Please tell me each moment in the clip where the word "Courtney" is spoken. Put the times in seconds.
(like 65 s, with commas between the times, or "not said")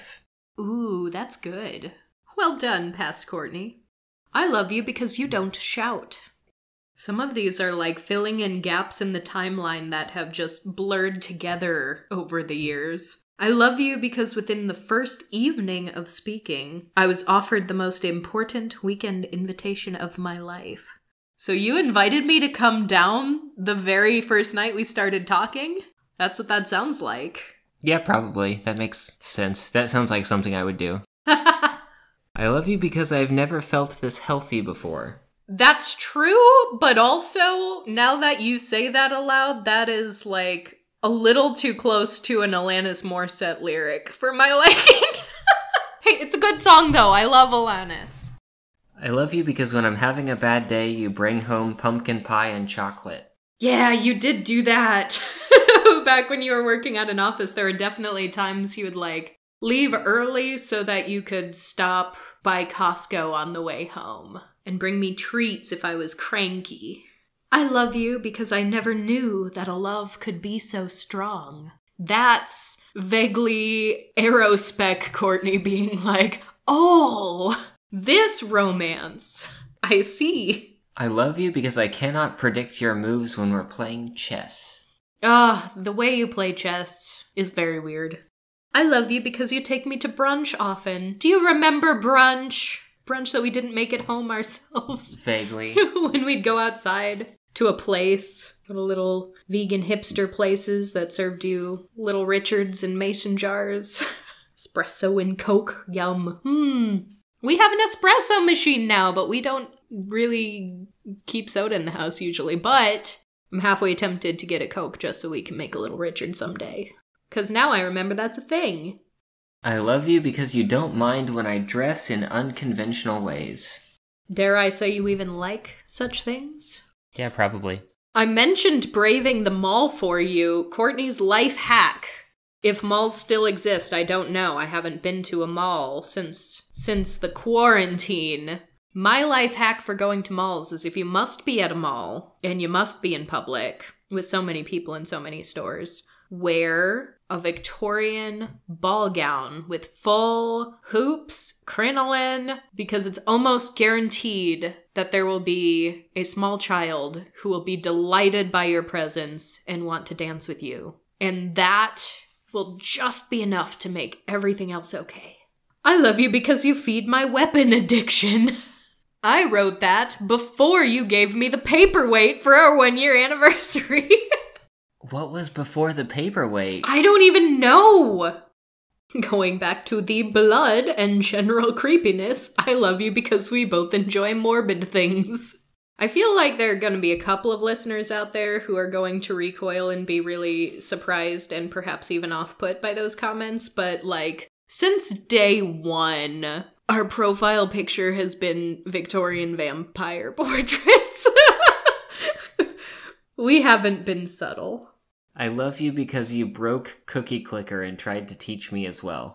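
3 s, 75 s, 130 s.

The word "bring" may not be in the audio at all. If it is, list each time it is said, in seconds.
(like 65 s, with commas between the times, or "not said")
51 s, 64 s.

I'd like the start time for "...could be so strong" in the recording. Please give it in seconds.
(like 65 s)
70 s.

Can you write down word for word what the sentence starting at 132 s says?
If malls still exist, I don't know.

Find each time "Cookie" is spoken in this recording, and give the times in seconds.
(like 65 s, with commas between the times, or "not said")
207 s.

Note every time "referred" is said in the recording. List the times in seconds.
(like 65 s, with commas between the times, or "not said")
not said.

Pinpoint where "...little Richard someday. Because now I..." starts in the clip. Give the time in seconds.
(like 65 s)
115 s.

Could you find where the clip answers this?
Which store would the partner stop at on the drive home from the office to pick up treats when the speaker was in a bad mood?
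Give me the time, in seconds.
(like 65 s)
62 s.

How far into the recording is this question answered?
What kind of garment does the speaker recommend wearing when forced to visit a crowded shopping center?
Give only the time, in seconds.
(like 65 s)
147 s.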